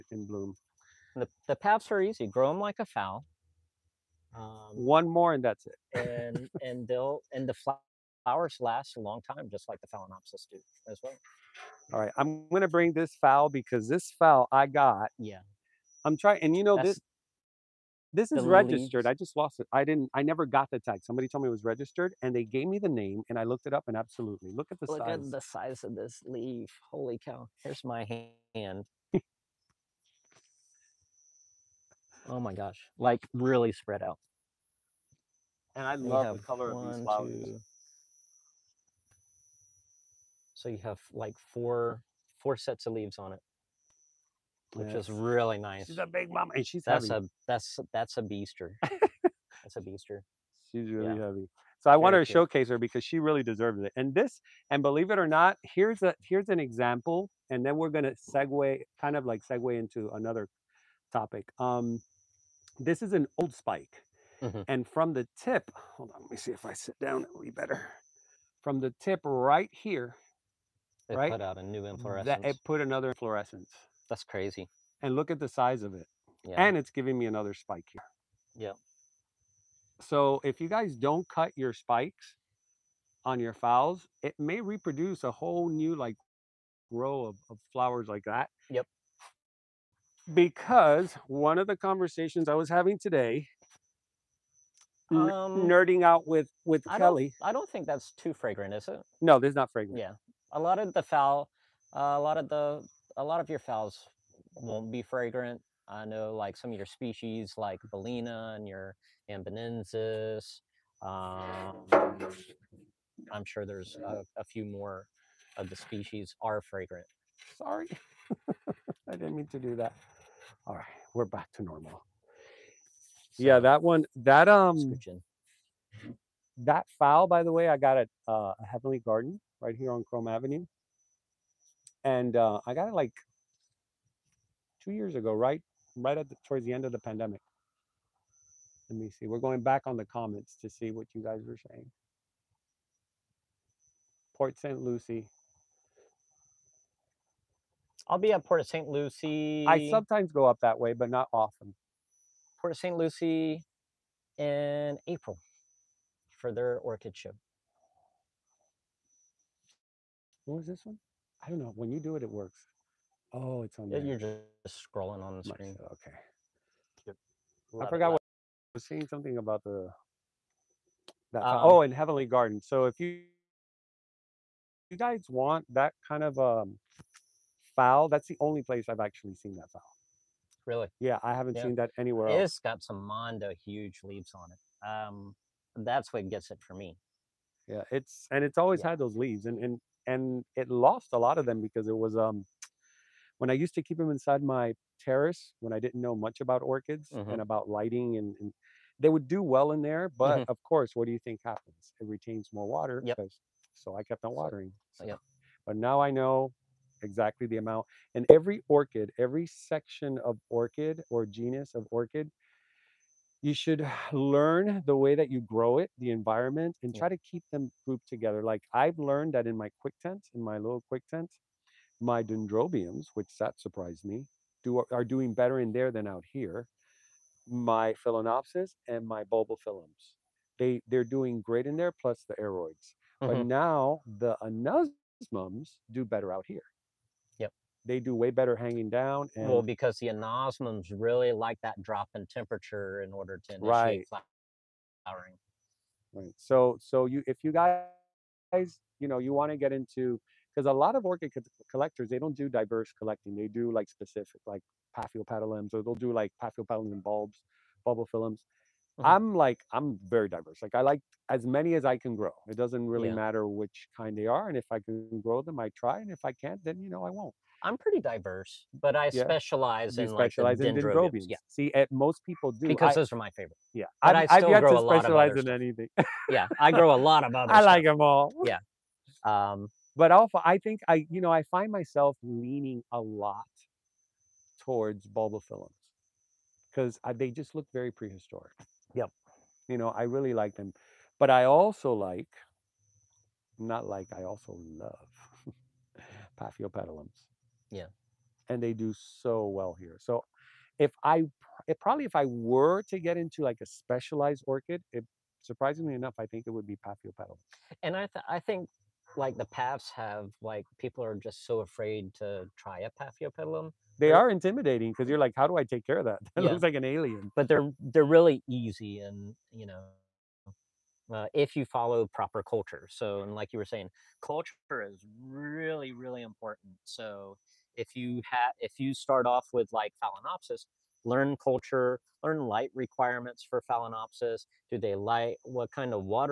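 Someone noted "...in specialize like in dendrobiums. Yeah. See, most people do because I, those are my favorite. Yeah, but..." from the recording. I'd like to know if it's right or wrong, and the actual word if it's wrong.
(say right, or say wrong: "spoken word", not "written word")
right.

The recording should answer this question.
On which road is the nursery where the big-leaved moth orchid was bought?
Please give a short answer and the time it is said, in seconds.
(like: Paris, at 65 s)
Krome Avenue, at 130 s.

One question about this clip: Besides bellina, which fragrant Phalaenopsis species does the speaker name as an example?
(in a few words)
amboinensis.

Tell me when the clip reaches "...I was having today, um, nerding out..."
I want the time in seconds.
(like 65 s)
92 s.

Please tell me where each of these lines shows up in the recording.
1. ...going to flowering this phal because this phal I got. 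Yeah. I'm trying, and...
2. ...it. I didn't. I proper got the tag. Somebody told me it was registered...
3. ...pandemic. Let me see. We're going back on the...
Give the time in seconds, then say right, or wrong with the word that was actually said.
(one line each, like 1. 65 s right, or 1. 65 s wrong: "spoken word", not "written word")
1. 12 s wrong: "bring", not "flowering"
2. 19 s wrong: "never", not "proper"
3. 136 s right.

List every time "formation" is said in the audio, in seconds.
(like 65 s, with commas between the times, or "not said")
not said.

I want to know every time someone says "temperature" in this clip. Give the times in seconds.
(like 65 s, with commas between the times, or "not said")
242 s.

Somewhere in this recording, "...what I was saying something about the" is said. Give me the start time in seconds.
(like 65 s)
168 s.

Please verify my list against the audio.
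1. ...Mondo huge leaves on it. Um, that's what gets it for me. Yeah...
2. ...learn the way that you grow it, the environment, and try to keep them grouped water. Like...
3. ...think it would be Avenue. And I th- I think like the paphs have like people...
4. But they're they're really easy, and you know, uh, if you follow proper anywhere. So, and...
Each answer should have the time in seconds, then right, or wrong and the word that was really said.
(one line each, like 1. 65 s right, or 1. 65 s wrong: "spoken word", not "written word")
1. 183 s right
2. 214 s wrong: "together", not "water"
3. 306 s wrong: "Paphiopedilum", not "Avenue"
4. 317 s wrong: "culture", not "anywhere".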